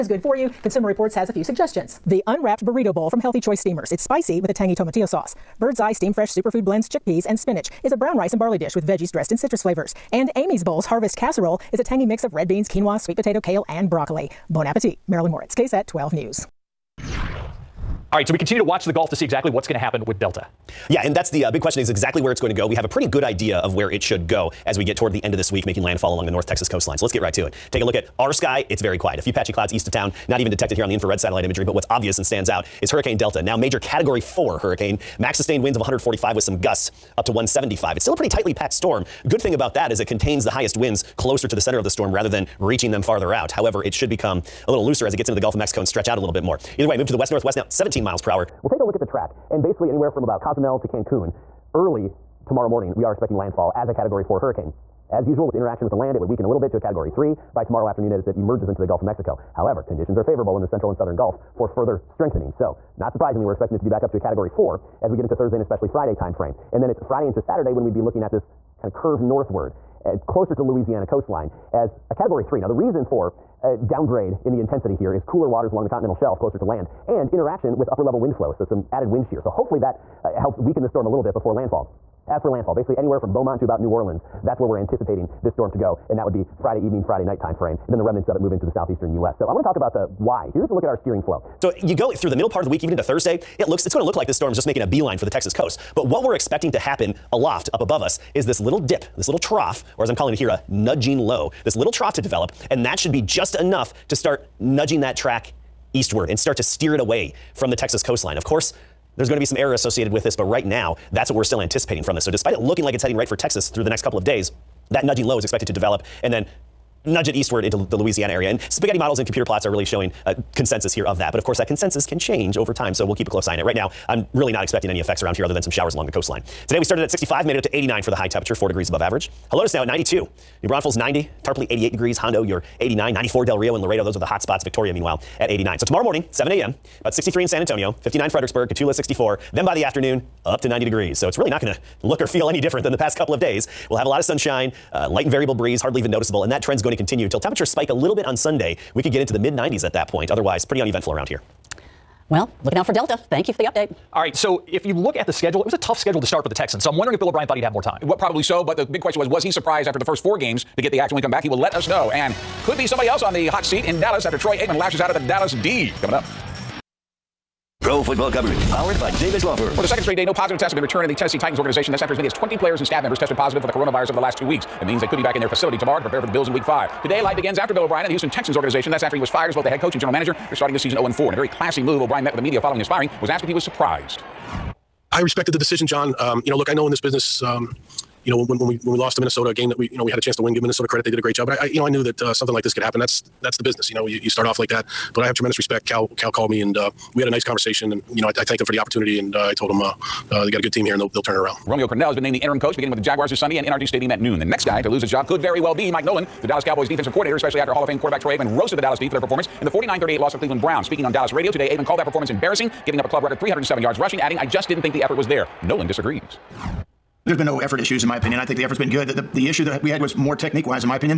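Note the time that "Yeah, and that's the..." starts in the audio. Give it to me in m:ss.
0:20.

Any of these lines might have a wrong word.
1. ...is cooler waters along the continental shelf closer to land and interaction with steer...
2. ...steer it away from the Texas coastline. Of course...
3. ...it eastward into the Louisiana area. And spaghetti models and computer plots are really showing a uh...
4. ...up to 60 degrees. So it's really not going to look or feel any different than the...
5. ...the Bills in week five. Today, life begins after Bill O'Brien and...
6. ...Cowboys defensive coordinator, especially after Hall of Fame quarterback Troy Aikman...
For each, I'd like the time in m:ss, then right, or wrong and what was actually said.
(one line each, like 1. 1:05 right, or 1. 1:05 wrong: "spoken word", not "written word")
1. 1:15 wrong: "upper", not "steer"
2. 1:46 right
3. 1:57 right
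4. 2:20 wrong: "90", not "60"
5. 2:56 right
6. 3:26 right.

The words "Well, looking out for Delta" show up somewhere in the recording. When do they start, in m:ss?
2:32.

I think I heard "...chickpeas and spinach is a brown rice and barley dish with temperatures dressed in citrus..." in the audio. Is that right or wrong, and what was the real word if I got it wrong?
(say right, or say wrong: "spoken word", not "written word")
wrong: "veggies", not "temperatures".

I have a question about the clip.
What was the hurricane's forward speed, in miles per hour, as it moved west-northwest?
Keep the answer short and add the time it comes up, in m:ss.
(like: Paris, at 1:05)
17, at 0:47.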